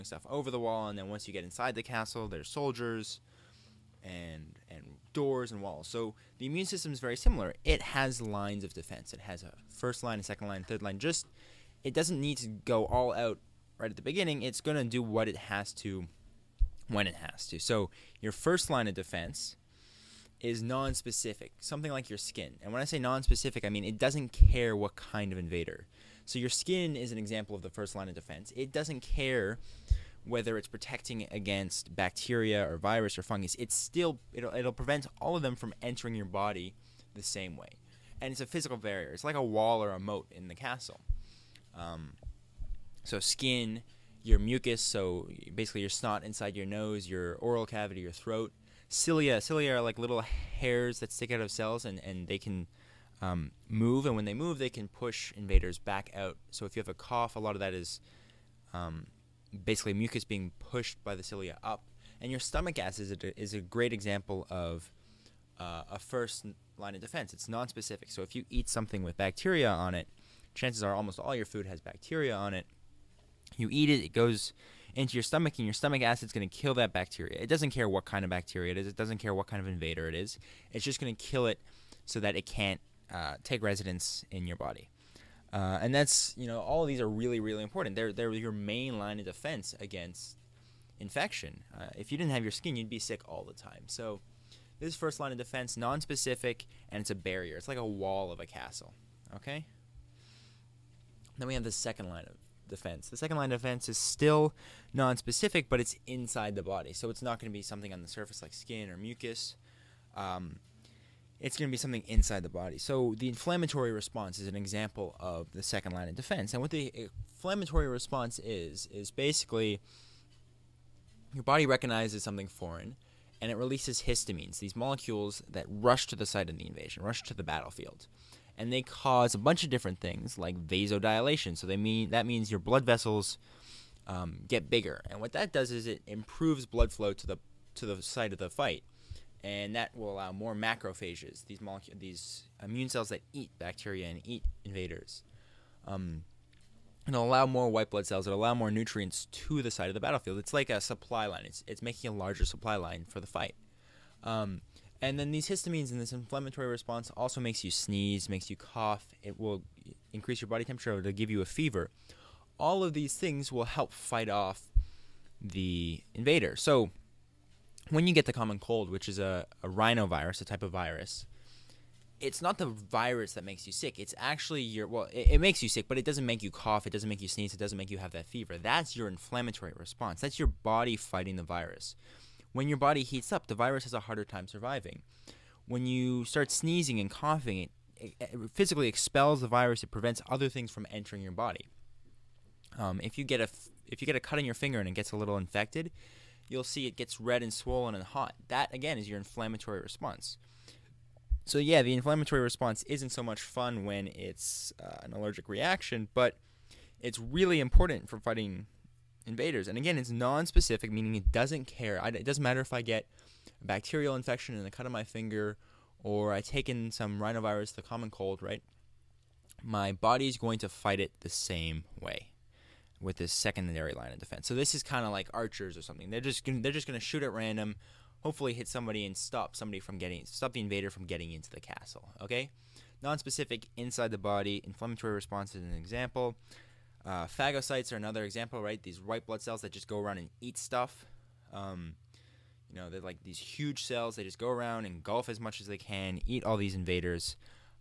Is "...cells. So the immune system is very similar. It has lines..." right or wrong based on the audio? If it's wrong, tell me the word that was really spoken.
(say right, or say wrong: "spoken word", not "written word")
wrong: "walls", not "cells".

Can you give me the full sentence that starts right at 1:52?
So the inflammatory response is an example of the second line of defense.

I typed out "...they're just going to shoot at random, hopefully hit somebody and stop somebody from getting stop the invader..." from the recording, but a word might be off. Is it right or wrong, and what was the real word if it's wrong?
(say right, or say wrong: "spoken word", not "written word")
right.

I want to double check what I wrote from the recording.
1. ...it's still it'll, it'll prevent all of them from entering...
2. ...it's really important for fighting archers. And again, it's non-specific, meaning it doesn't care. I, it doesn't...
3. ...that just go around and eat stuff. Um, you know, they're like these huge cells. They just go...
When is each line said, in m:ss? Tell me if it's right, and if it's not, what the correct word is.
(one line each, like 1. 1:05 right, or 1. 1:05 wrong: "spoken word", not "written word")
1. 0:33 right
2. 3:27 wrong: "invaders", not "archers"
3. 3:59 right.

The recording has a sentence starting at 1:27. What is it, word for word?
They're they're your main line of defense against infection.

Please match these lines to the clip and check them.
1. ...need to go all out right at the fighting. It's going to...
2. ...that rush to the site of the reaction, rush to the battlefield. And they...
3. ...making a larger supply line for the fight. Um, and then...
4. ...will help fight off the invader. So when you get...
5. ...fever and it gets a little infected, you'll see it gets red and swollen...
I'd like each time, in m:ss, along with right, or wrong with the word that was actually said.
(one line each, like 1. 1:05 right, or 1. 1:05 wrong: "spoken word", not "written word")
1. 0:12 wrong: "beginning", not "fighting"
2. 2:05 wrong: "invasion", not "reaction"
3. 2:31 right
4. 2:43 right
5. 3:14 wrong: "finger", not "fever".